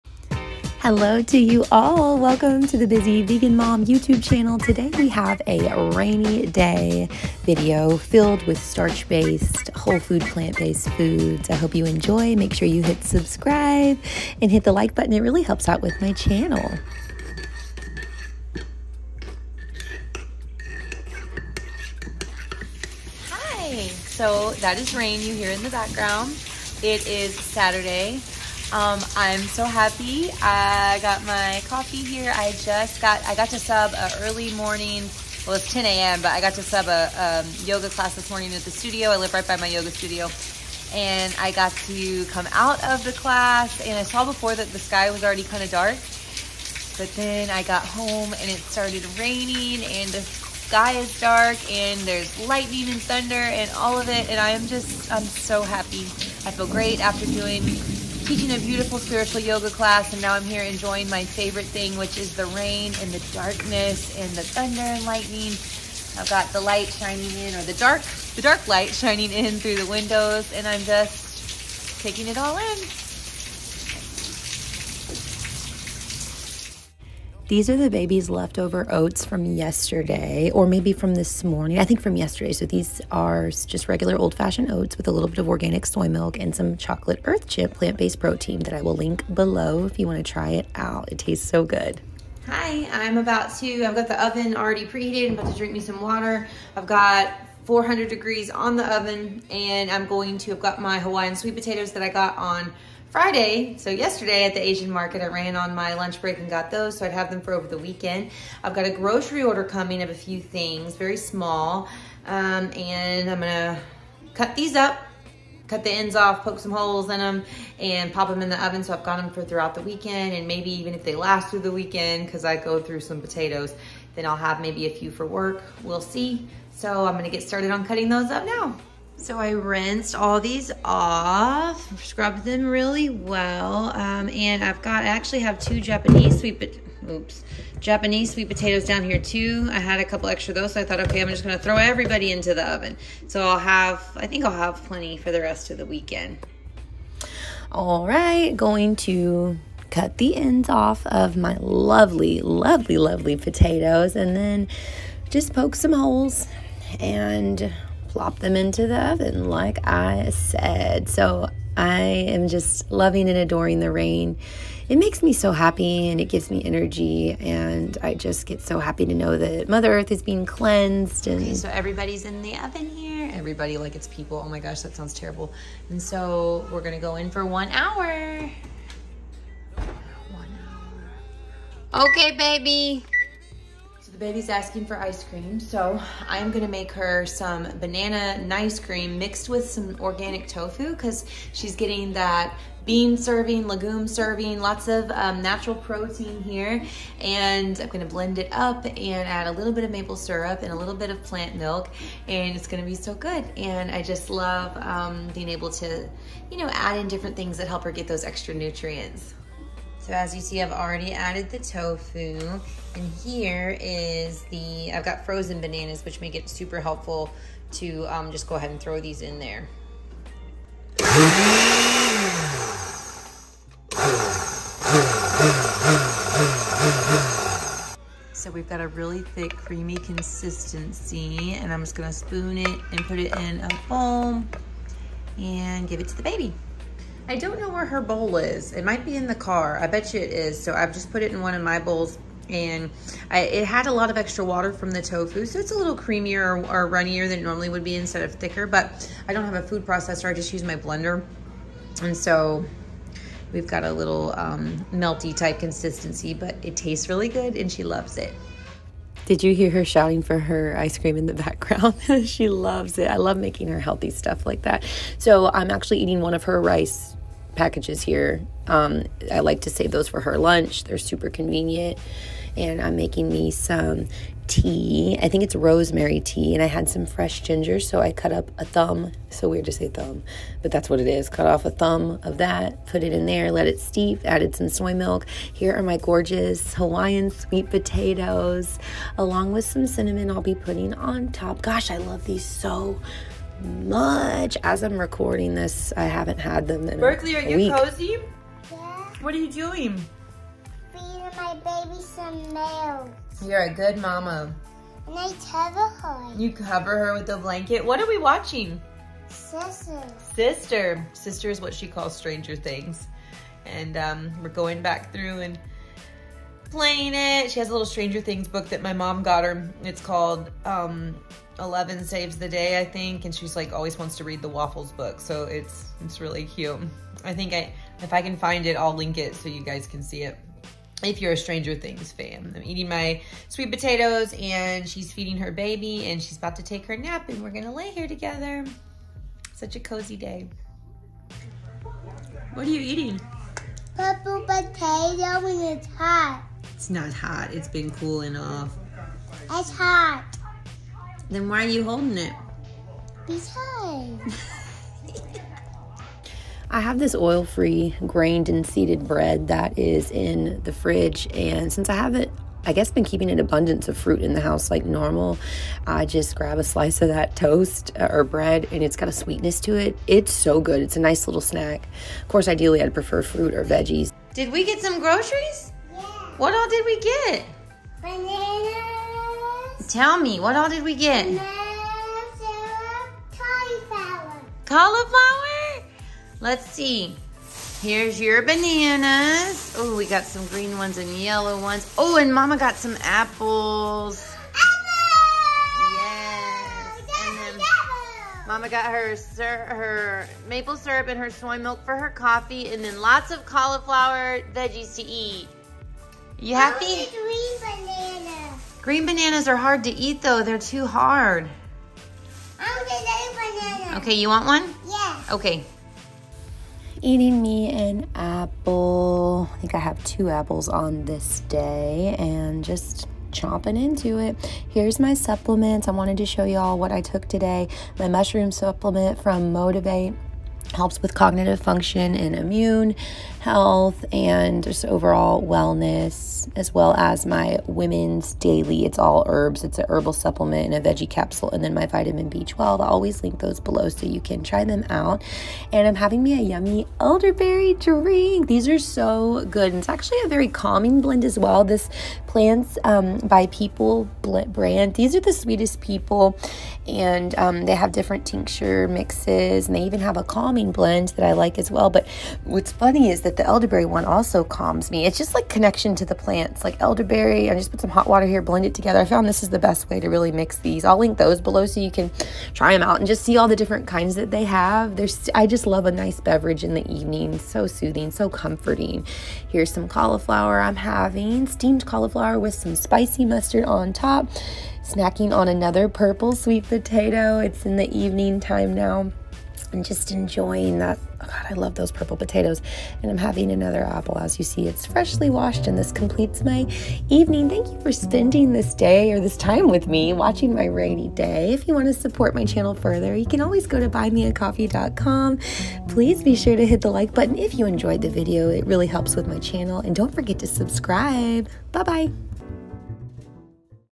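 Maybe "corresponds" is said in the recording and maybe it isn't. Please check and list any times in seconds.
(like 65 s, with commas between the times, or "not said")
not said.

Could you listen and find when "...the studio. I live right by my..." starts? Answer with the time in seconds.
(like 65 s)
38 s.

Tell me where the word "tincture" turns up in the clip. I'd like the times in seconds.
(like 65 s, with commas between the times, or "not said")
458 s.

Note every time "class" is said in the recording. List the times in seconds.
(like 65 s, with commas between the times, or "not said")
37 s, 43 s, 59 s.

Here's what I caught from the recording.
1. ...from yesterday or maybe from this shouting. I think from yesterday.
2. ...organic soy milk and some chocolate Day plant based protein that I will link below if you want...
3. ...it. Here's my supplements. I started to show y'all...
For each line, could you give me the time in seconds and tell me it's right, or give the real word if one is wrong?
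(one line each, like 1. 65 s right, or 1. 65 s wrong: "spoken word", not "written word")
1. 79 s wrong: "morning", not "shouting"
2. 85 s wrong: "Earthchimp", not "Day"
3. 424 s wrong: "wanted", not "started".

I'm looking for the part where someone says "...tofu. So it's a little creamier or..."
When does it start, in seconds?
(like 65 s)
245 s.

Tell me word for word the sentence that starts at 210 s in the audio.
So as you see, I've already added the tofu.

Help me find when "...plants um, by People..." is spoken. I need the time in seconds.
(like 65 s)
452 s.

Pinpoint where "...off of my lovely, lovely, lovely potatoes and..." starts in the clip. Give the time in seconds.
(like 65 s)
150 s.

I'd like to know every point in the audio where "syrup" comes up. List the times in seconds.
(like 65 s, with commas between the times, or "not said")
200 s, 400 s.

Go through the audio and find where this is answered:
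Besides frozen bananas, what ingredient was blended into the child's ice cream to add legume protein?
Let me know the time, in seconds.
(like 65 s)
189 s.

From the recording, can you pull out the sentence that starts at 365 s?
I just grab a slice of that toast uh, or bread and it's got a sweetness to it.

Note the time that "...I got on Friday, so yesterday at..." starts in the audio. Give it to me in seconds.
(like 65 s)
102 s.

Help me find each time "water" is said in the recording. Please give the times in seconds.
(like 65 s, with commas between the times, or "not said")
95 s, 244 s, 468 s.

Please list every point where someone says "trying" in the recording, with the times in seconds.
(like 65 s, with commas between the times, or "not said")
not said.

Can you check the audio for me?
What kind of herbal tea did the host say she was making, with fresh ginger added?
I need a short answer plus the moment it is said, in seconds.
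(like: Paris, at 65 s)
Rosemary tea, at 275 s.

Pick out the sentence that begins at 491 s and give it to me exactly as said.
Oh God, I love those purple potatoes.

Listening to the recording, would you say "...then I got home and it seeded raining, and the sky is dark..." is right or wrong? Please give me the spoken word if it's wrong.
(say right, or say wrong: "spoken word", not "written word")
wrong: "started", not "seeded".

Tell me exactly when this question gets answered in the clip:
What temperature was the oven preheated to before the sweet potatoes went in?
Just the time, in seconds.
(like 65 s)
97 s.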